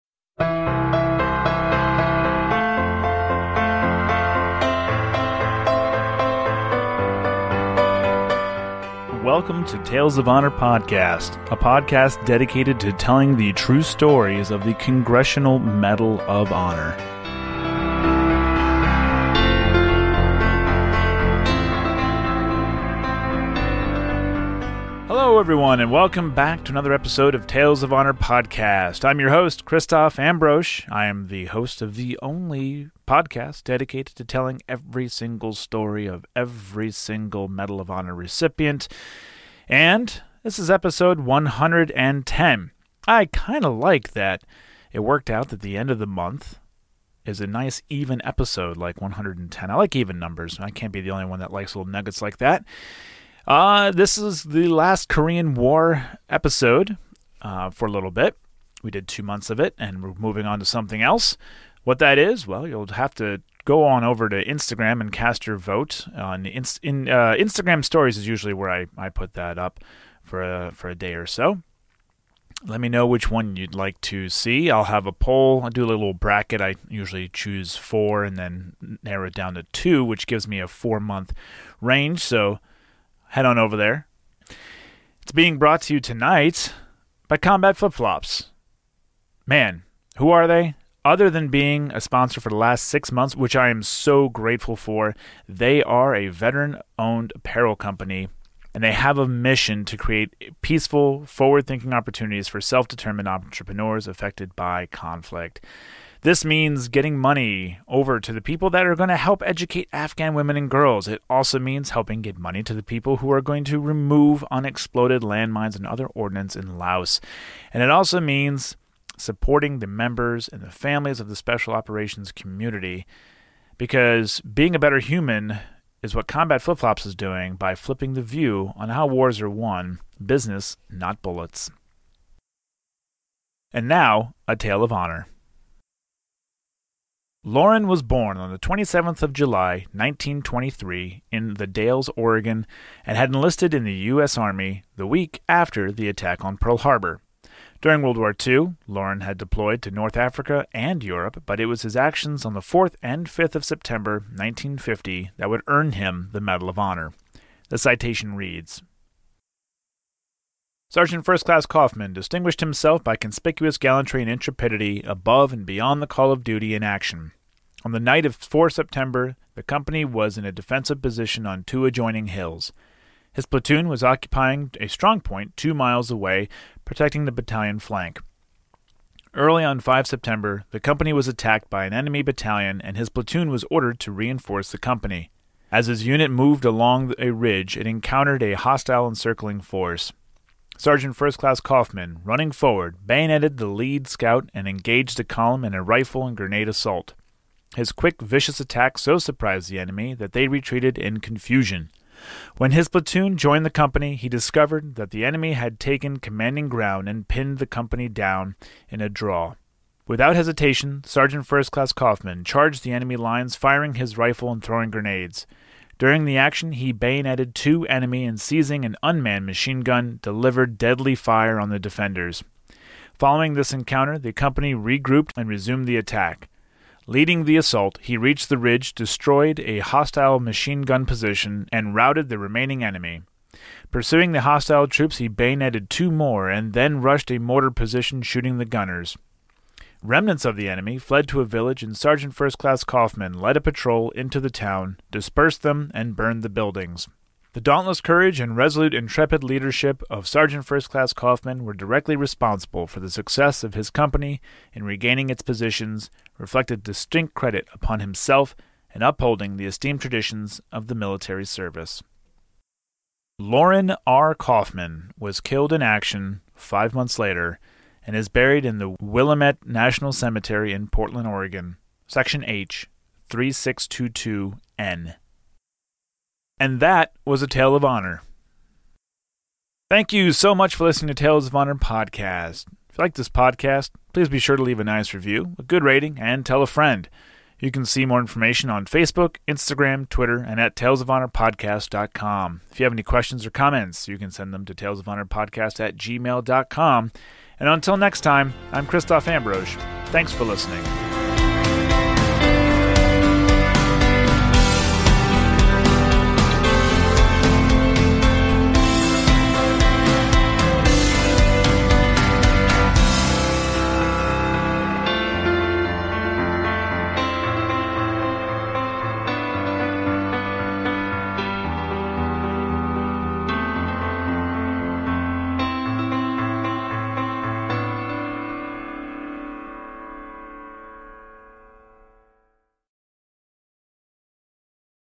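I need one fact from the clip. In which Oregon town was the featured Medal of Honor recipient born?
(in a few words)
The Dalles.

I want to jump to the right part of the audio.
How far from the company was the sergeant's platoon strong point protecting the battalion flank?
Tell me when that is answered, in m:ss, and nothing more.
2:55.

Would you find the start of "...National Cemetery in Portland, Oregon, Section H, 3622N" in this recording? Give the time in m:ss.
4:29.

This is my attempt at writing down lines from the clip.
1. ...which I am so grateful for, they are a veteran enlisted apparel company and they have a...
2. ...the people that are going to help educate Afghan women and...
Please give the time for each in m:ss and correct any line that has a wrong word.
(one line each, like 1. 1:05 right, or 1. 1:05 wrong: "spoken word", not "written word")
1. 1:33 wrong: "owned", not "enlisted"
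2. 1:48 right.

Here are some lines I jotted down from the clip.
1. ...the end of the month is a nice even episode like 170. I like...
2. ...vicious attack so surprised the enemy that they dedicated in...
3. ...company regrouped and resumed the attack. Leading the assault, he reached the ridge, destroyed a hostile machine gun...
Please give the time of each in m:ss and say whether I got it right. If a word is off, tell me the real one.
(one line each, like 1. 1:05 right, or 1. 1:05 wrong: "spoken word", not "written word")
1. 0:45 wrong: "110", not "170"
2. 3:18 wrong: "retreated", not "dedicated"
3. 3:44 right.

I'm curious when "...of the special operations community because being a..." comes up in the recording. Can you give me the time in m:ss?
2:01.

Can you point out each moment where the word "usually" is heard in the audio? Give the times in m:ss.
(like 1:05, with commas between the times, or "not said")
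1:08, 1:16.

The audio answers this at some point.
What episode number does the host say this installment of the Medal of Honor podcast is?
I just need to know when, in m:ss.
0:40.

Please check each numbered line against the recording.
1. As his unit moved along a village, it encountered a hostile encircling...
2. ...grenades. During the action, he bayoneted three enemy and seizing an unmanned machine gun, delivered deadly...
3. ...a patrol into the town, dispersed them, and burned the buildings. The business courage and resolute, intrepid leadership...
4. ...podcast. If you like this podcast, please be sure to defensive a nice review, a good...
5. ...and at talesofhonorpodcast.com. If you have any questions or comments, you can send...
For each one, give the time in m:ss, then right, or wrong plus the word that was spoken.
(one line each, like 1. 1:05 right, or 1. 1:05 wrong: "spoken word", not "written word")
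1. 3:05 wrong: "ridge", not "village"
2. 3:34 wrong: "two", not "three"
3. 4:03 wrong: "dauntless", not "business"
4. 4:41 wrong: "leave", not "defensive"
5. 4:50 right.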